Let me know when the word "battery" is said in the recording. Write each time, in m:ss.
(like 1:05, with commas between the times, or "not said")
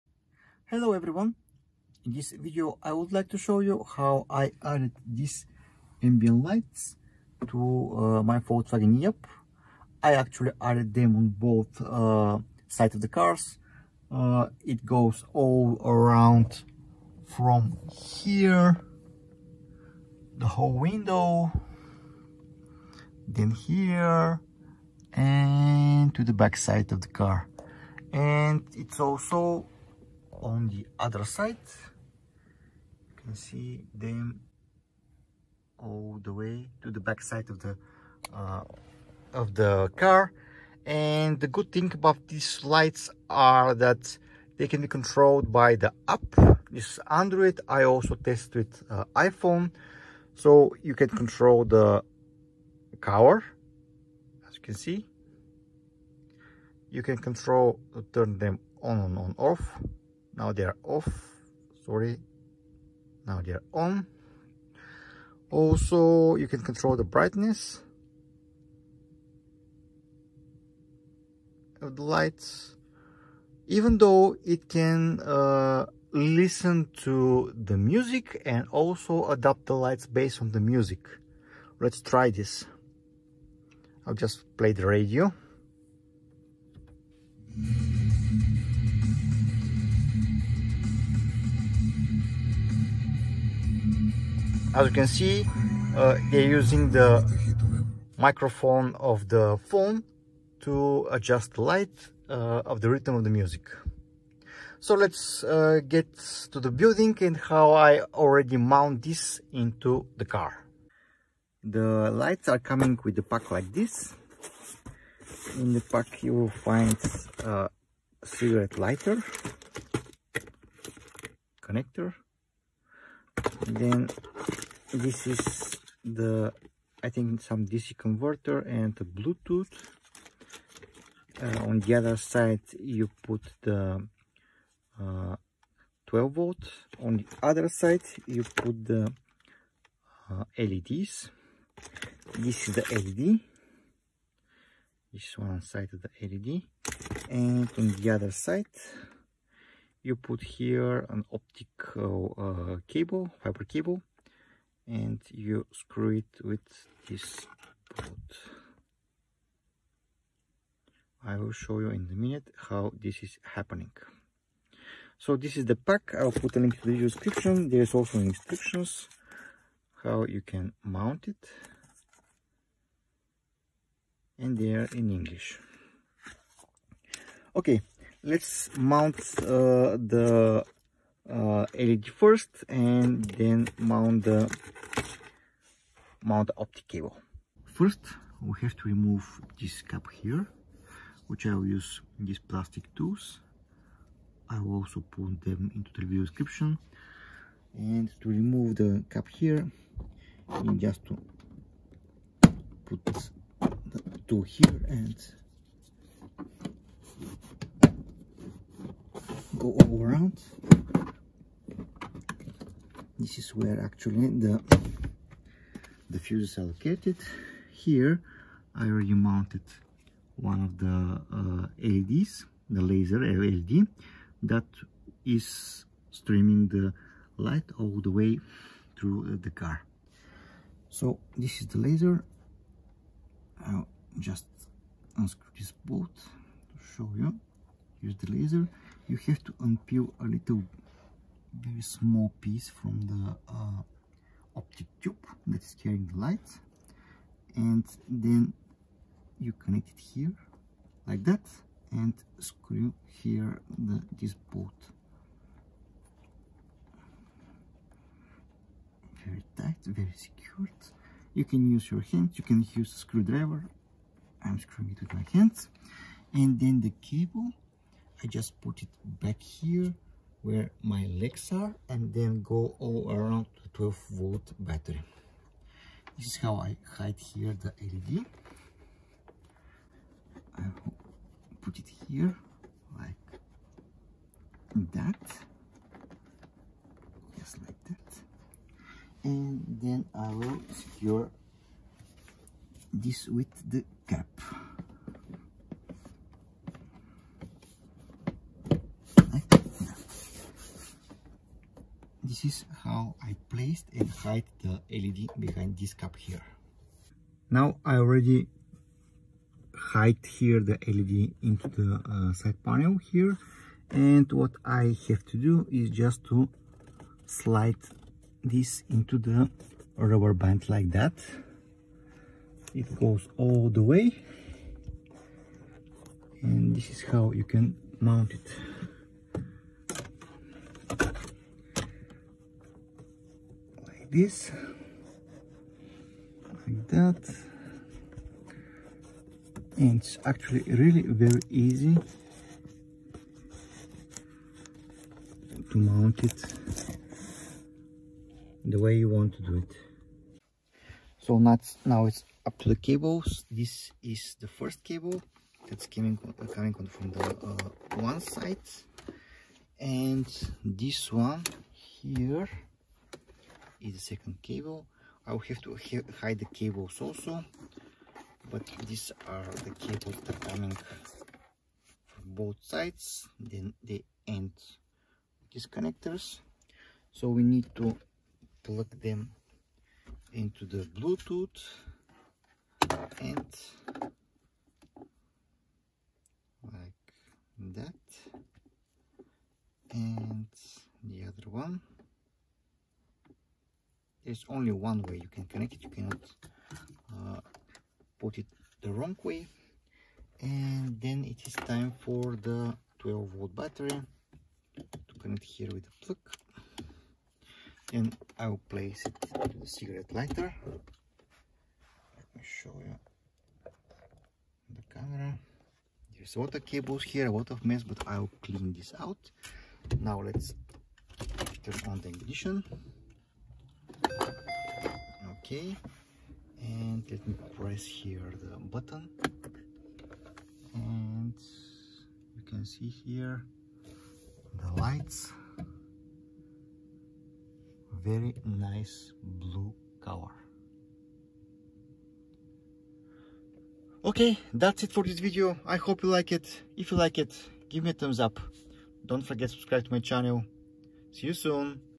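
4:34, 6:43.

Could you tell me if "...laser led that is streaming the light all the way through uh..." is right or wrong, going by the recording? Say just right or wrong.
right.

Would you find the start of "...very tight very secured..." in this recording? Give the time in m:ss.
4:19.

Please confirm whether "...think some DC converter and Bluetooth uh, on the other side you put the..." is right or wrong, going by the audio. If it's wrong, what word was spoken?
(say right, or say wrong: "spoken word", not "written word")
right.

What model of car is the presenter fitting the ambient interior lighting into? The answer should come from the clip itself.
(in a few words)
Volkswagen e-up.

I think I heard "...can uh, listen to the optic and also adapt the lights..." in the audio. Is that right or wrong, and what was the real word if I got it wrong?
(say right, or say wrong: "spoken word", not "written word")
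wrong: "music", not "optic".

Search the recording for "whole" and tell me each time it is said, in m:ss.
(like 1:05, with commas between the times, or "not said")
0:20.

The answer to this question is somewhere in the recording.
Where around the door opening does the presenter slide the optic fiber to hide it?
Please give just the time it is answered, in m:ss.
5:19.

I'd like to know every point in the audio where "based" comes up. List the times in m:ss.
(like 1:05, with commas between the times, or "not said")
1:20.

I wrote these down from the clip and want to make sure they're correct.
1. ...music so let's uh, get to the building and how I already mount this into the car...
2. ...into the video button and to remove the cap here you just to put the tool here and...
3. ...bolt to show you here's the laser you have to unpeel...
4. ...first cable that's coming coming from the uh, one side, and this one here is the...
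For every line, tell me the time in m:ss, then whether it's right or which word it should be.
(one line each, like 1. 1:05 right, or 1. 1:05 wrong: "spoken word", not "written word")
1. 1:43 right
2. 3:15 wrong: "description", not "button"
3. 3:55 right
4. 5:54 right.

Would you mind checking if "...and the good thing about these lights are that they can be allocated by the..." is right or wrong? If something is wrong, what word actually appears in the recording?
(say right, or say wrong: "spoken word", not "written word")
wrong: "controlled", not "allocated".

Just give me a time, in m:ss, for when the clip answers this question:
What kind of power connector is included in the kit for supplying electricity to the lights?
1:58.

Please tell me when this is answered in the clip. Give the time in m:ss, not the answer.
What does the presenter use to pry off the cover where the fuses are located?
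3:12.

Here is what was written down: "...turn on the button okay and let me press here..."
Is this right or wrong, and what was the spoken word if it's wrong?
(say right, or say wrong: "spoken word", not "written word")
wrong: "ignition", not "button".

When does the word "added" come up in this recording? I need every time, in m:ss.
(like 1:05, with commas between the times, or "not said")
0:04, 0:10.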